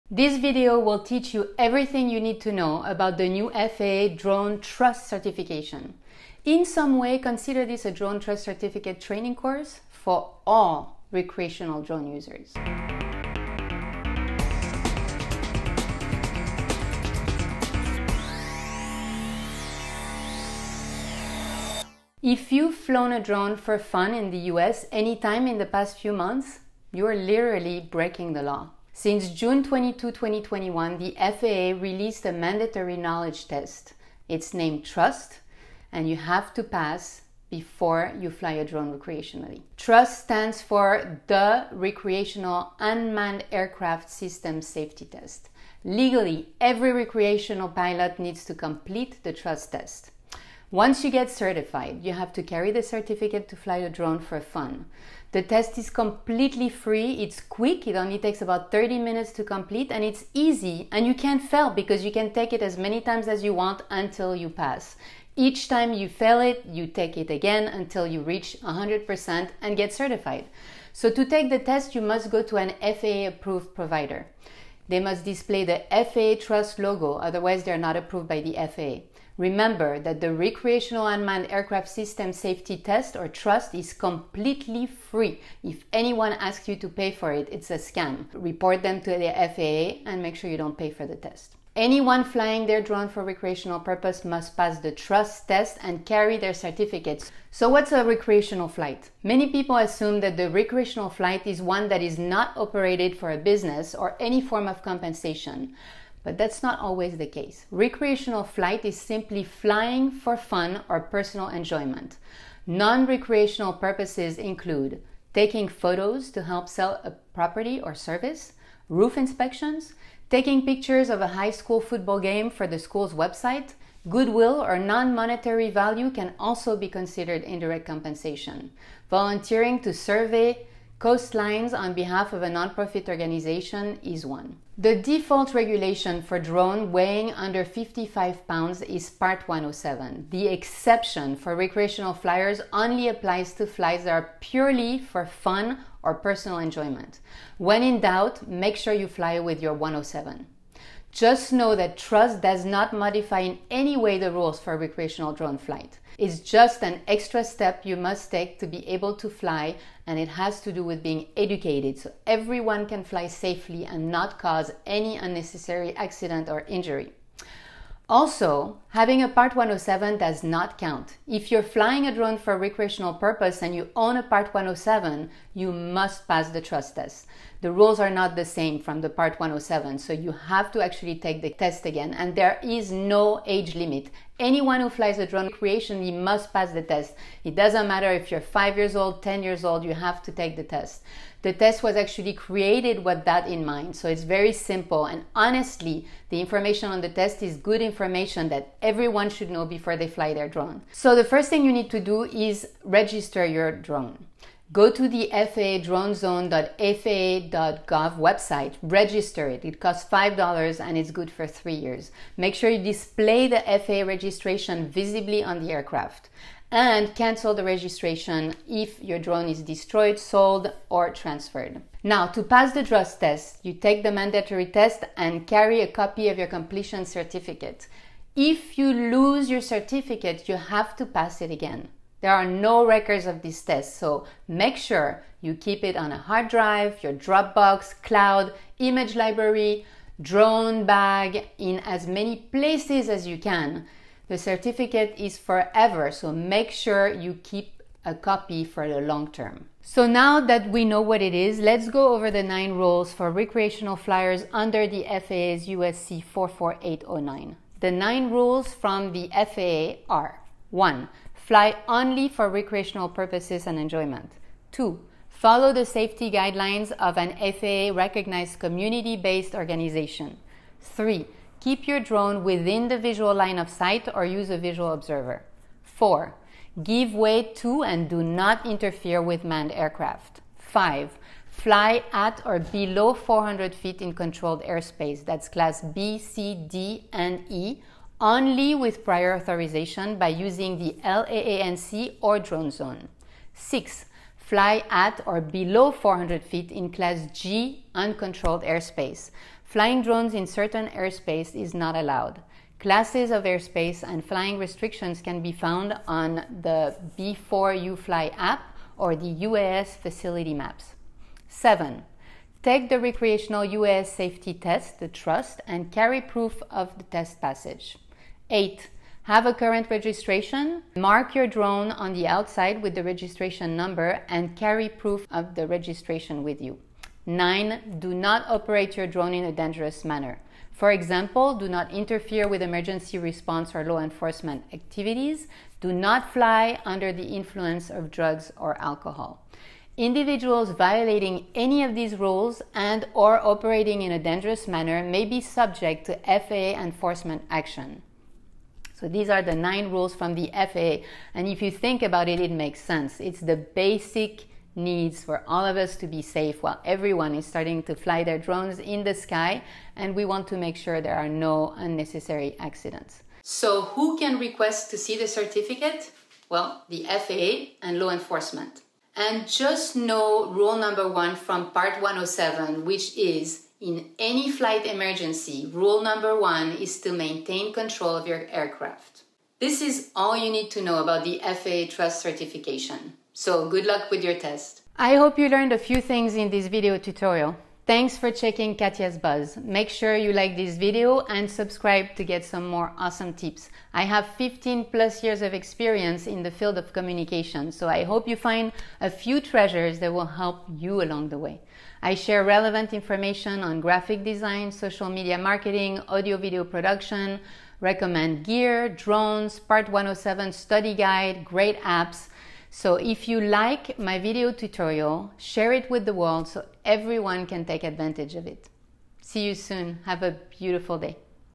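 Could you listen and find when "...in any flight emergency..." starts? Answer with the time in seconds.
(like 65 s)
373 s.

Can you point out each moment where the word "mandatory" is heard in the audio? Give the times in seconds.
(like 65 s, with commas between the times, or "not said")
32 s, 224 s.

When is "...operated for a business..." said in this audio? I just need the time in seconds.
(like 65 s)
102 s.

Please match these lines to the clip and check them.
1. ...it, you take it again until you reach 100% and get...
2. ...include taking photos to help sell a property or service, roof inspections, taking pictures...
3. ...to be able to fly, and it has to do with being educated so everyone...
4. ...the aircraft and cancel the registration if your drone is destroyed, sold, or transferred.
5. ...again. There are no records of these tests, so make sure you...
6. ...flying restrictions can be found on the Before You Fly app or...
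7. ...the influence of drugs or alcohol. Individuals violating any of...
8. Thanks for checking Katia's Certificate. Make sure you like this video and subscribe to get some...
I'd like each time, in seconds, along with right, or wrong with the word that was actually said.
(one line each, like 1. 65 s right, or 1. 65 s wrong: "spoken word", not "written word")
1. 66 s right
2. 114 s right
3. 158 s right
4. 215 s right
5. 231 s right
6. 304 s right
7. 337 s right
8. 387 s wrong: "Buzz", not "Certificate".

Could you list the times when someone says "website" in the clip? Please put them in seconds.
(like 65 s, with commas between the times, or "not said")
123 s, 208 s.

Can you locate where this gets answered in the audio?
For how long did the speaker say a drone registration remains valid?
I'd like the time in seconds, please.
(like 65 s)
211 s.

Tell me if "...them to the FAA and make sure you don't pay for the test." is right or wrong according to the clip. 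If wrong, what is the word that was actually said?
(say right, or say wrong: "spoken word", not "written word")
right.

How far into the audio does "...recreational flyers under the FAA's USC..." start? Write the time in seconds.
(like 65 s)
253 s.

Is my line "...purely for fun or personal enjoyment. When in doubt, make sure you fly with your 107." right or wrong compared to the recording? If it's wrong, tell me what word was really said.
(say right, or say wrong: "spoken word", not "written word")
right.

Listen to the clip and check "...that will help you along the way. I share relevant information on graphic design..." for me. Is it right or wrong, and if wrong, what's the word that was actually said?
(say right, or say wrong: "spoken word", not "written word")
right.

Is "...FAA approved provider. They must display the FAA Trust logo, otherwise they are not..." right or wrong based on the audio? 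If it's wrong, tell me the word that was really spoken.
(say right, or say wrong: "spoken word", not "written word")
right.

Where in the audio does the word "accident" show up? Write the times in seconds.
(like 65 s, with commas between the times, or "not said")
165 s, 362 s.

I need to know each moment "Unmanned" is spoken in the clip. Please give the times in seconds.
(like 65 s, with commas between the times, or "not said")
42 s, 81 s.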